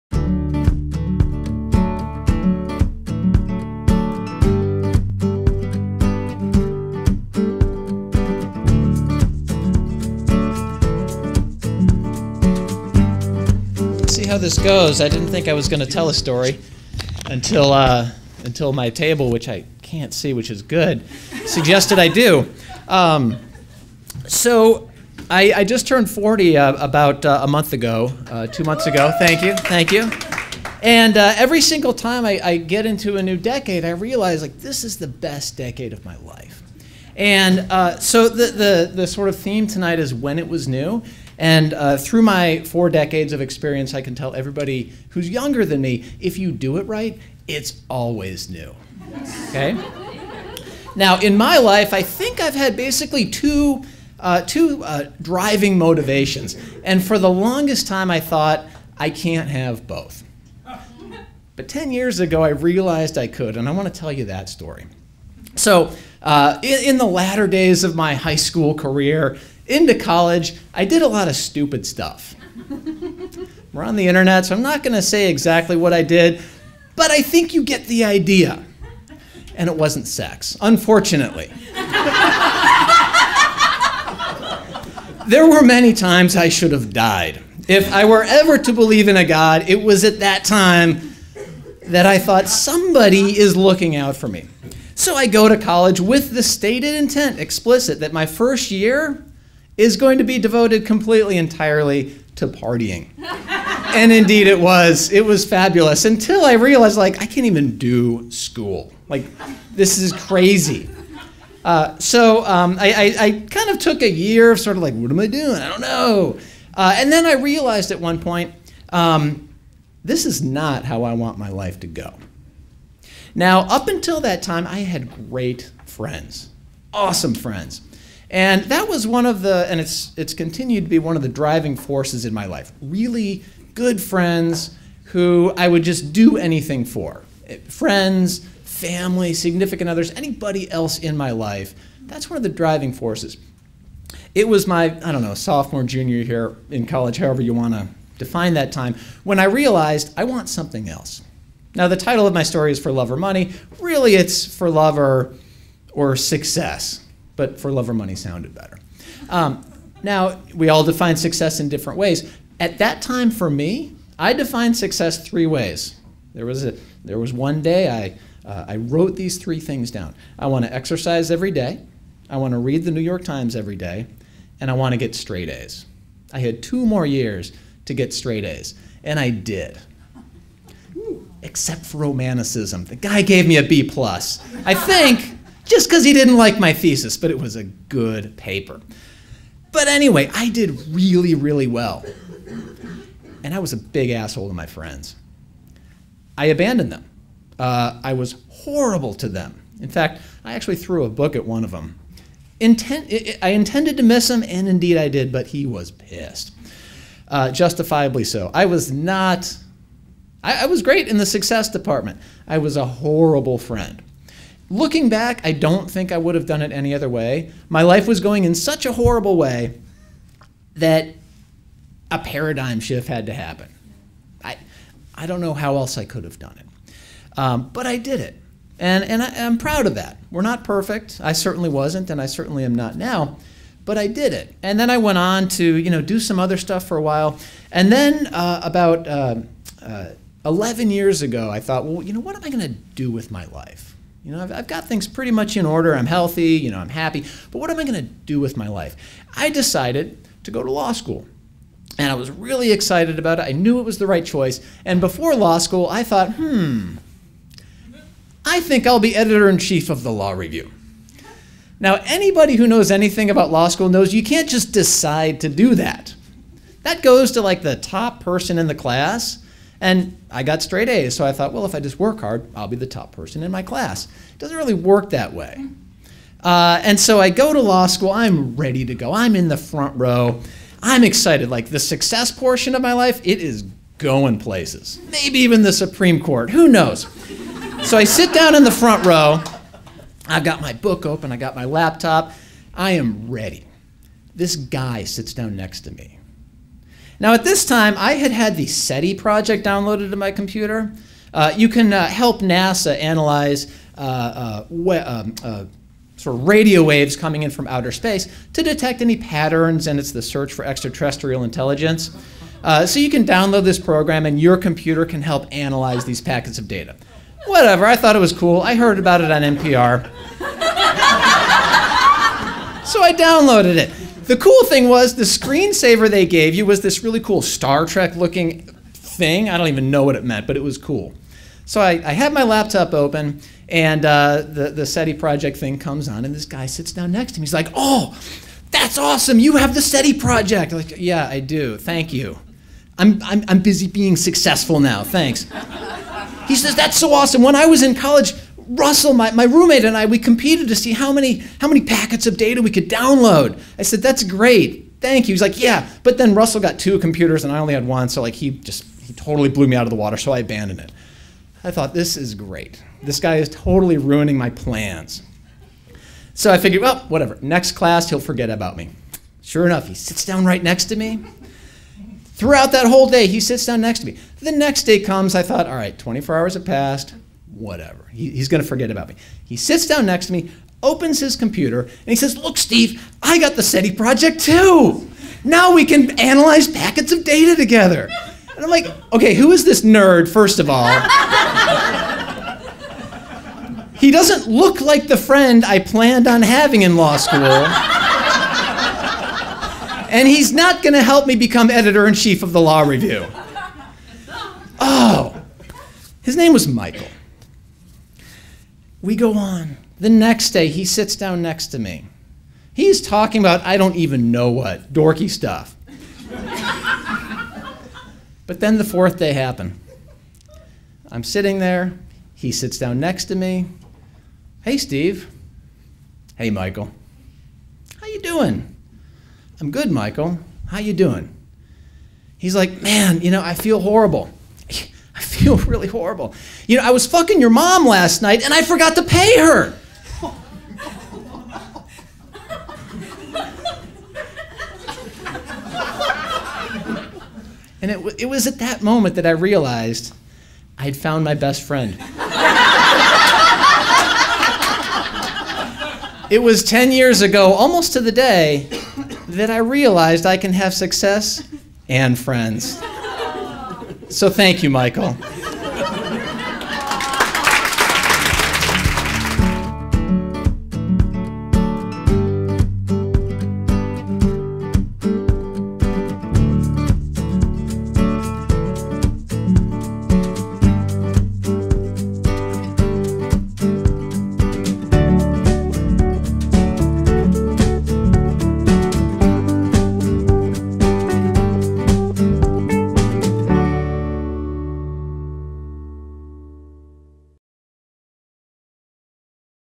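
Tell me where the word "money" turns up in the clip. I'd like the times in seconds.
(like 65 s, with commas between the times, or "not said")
153 s, 157 s.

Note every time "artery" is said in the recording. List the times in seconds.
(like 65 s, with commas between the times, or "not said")
not said.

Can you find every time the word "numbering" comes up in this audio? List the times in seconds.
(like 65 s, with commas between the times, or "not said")
not said.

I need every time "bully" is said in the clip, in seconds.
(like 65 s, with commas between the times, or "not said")
not said.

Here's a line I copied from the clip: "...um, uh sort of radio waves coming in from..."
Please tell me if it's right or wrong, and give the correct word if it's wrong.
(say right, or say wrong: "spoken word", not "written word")
right.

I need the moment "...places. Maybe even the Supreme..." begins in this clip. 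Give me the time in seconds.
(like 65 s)
284 s.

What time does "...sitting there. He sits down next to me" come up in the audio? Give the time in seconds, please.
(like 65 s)
421 s.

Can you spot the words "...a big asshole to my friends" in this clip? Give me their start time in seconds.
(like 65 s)
193 s.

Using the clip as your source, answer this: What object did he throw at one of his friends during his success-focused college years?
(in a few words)
A book.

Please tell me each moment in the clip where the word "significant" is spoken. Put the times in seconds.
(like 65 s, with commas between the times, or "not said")
139 s.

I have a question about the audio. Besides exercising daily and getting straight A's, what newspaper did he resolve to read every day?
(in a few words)
The New York Times.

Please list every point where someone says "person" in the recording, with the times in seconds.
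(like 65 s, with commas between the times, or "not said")
268 s, 273 s.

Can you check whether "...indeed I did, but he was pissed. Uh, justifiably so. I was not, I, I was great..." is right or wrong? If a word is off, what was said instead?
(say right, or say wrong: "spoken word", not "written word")
right.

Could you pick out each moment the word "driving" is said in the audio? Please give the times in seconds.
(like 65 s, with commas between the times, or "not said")
55 s, 131 s, 142 s.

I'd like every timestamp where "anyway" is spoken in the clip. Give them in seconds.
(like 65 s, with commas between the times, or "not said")
189 s.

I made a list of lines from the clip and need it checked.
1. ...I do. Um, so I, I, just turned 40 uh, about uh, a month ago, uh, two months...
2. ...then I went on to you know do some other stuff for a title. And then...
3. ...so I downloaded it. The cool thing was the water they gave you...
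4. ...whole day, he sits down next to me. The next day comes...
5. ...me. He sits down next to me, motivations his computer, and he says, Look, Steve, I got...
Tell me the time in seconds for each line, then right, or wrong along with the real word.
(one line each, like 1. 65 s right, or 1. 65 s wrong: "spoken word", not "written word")
1. 21 s right
2. 234 s wrong: "while", not "title"
3. 322 s wrong: "screensaver", not "water"
4. 372 s right
5. 379 s wrong: "opens", not "motivations".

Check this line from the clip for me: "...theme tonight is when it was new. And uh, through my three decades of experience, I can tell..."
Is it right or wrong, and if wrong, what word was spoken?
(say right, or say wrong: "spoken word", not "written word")
wrong: "four", not "three".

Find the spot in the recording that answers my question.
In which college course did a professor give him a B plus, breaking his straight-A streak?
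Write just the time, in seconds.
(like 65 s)
181 s.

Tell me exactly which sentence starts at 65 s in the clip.
So, uh, in, in, the latter days of my high school career, into college, I did a lot of stupid stuff.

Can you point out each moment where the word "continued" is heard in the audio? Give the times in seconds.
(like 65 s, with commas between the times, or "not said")
130 s.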